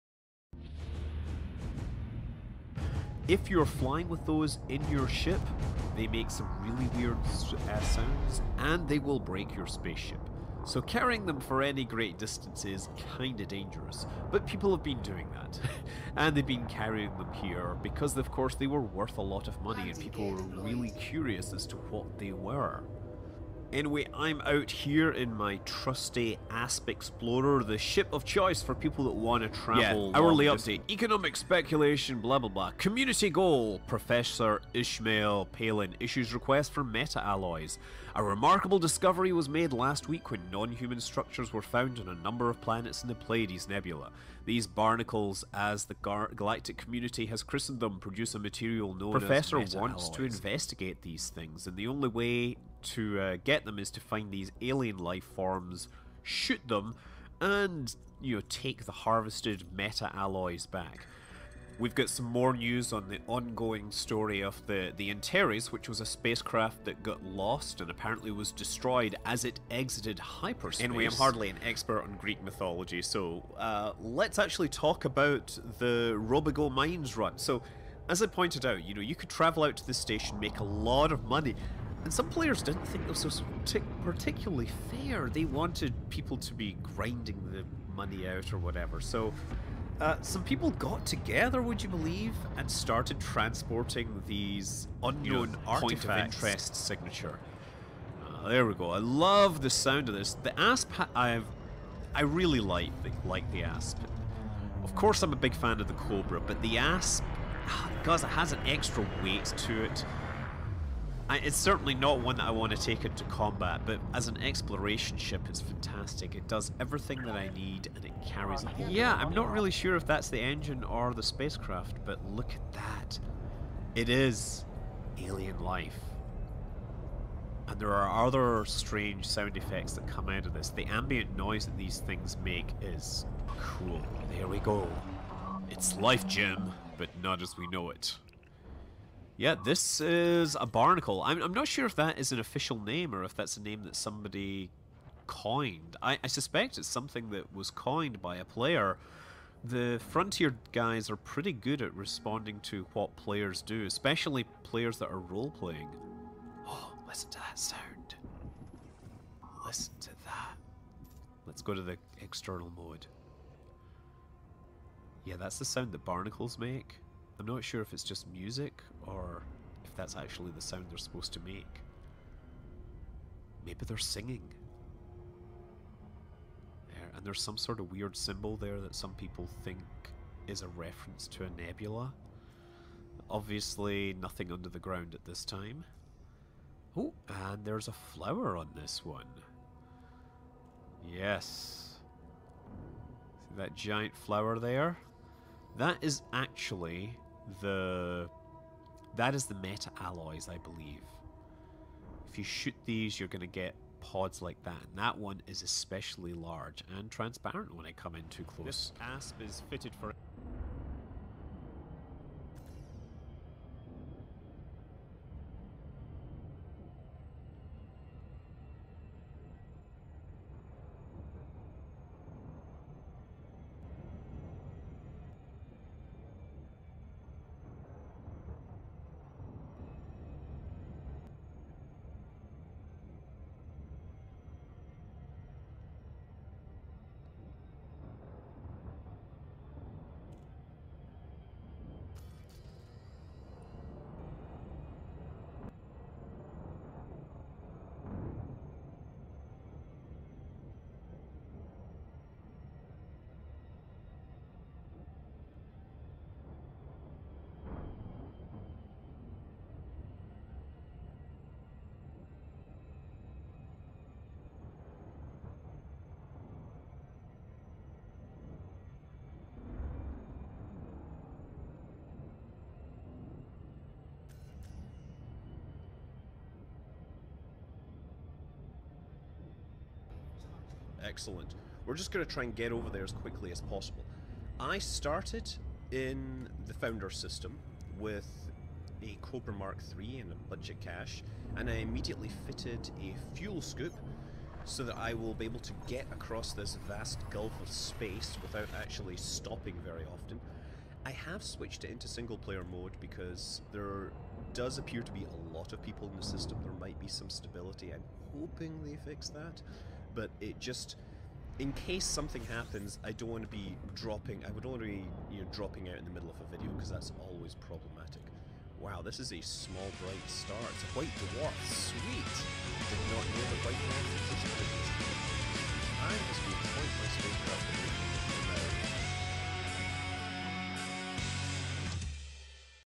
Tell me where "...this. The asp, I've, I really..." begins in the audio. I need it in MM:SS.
01:40.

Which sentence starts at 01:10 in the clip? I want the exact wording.
Anyway, I'm hardly an expert on Greek mythology, so uh, let's actually talk about the Robigo Mines run.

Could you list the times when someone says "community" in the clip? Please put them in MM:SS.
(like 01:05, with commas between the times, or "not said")
00:32, 00:46.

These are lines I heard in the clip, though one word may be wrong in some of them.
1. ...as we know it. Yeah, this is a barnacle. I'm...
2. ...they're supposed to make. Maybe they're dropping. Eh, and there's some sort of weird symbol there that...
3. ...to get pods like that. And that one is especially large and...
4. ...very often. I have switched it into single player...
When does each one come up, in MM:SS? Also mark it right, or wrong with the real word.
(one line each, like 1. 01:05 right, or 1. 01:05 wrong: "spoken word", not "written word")
1. 02:17 right
2. 02:50 wrong: "singing", not "dropping"
3. 03:23 right
4. 04:59 right.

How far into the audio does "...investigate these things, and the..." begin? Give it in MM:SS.
00:50.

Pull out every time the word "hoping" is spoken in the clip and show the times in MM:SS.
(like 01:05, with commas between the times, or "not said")
05:08.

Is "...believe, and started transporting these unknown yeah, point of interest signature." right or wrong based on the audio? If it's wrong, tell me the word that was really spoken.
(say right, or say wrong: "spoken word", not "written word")
right.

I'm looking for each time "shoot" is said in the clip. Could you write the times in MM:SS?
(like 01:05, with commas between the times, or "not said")
00:56, 03:22.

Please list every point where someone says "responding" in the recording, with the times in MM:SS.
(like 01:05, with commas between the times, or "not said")
02:31.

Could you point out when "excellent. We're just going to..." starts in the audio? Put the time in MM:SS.
04:41.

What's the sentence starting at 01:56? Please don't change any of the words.
It does everything that I need, and it carries...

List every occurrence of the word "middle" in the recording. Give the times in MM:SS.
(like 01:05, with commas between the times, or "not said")
05:16.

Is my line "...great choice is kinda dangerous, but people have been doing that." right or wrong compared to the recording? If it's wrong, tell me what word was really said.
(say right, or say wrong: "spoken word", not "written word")
wrong: "distance", not "choice".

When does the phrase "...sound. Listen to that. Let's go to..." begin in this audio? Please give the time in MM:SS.
02:37.